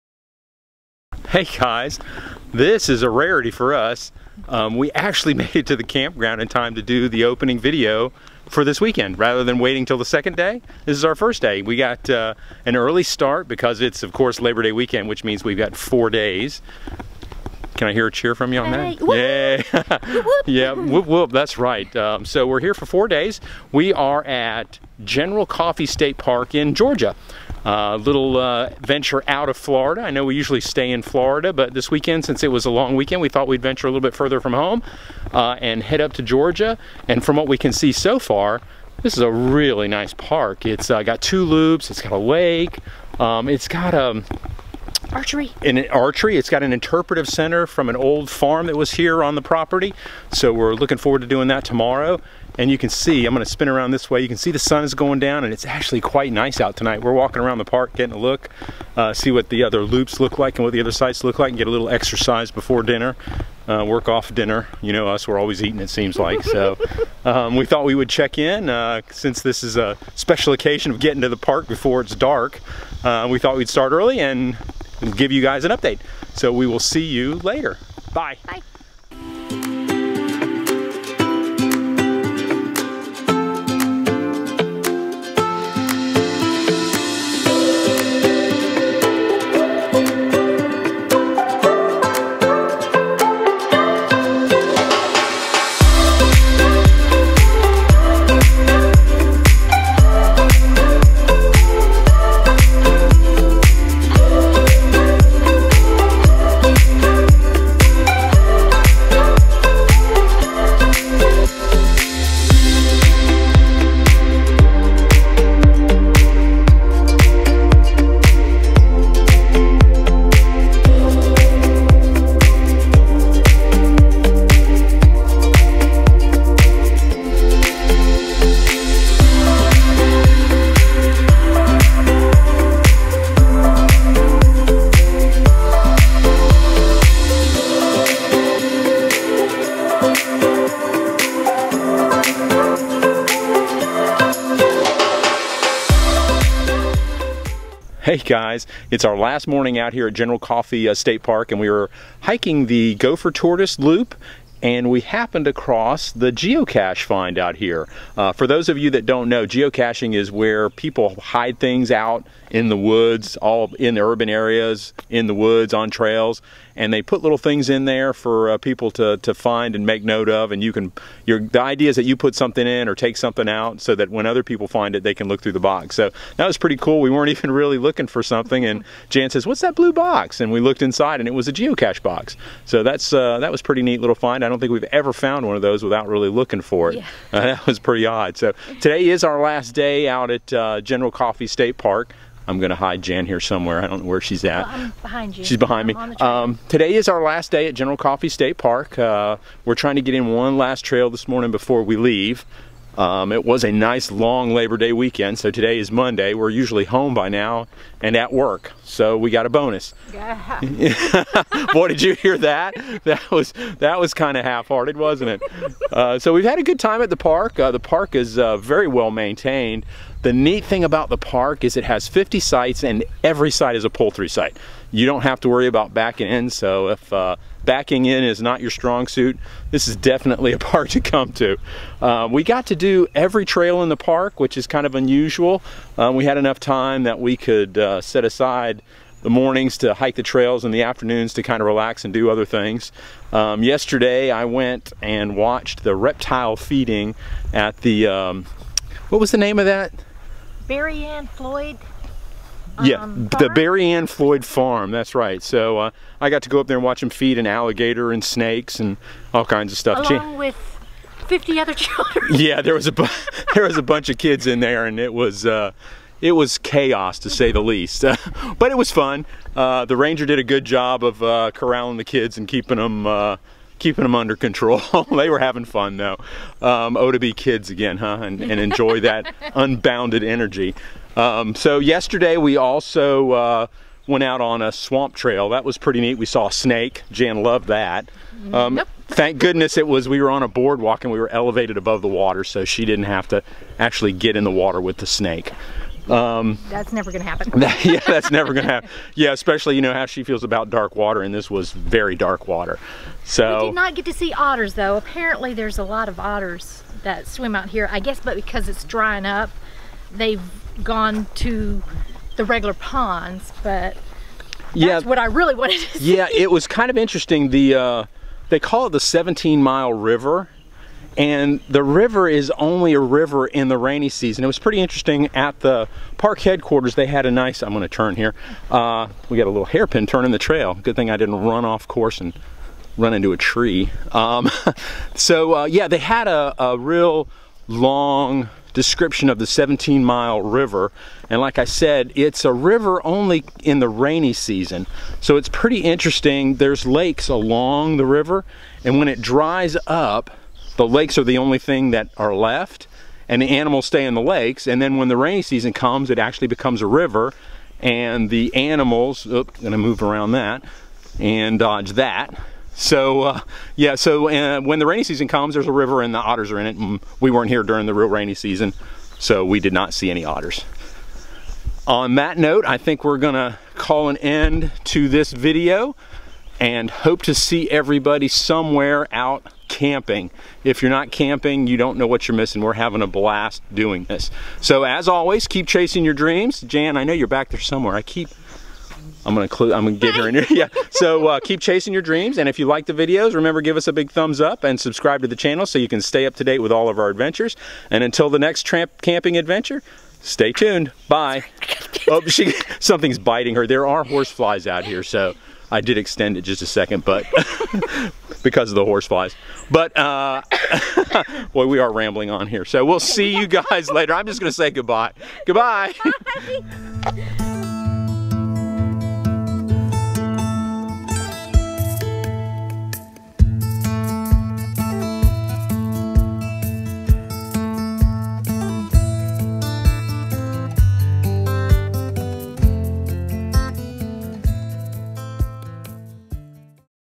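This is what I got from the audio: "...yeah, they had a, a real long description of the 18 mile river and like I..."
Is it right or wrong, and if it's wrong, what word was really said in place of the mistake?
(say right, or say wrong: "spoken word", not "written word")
wrong: "17", not "18".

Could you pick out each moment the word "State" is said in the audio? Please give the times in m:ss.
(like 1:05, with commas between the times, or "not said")
0:25, 2:30, 3:11, 3:18.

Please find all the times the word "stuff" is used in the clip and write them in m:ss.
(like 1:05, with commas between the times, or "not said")
4:19.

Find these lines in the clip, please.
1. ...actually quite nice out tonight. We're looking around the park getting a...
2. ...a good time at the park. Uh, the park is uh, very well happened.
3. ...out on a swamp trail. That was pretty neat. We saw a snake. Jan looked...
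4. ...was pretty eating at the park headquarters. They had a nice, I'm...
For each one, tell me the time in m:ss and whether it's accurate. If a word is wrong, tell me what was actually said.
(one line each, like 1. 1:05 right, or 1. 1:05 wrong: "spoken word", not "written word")
1. 0:55 wrong: "walking", not "looking"
2. 3:36 wrong: "maintained", not "happened"
3. 4:44 wrong: "loved", not "looked"
4. 5:24 wrong: "interesting", not "eating".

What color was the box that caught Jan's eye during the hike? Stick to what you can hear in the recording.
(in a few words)
Blue.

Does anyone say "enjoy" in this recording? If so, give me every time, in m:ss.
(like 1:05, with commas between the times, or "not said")
4:38.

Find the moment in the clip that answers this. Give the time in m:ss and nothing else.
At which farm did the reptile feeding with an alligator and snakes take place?
4:13.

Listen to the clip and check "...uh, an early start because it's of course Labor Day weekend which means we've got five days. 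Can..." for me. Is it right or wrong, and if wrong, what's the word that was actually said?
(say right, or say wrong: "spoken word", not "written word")
wrong: "four", not "five".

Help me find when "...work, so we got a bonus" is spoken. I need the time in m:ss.
3:28.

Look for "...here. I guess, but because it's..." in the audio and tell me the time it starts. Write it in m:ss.
5:07.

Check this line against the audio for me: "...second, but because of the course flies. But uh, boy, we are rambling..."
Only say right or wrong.
wrong.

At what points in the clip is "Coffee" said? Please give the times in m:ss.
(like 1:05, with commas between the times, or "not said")
0:25, 2:30, 3:11, 3:17.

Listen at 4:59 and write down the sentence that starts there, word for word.
Yeah, especially you know how she feels about dark water, and this was very dark water.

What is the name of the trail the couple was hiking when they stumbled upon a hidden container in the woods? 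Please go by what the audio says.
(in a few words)
Gopher Tortoise Loop.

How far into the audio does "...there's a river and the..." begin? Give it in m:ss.
6:05.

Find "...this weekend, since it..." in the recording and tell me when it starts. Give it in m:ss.
0:31.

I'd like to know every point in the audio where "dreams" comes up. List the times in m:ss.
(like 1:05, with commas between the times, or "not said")
6:26, 6:32.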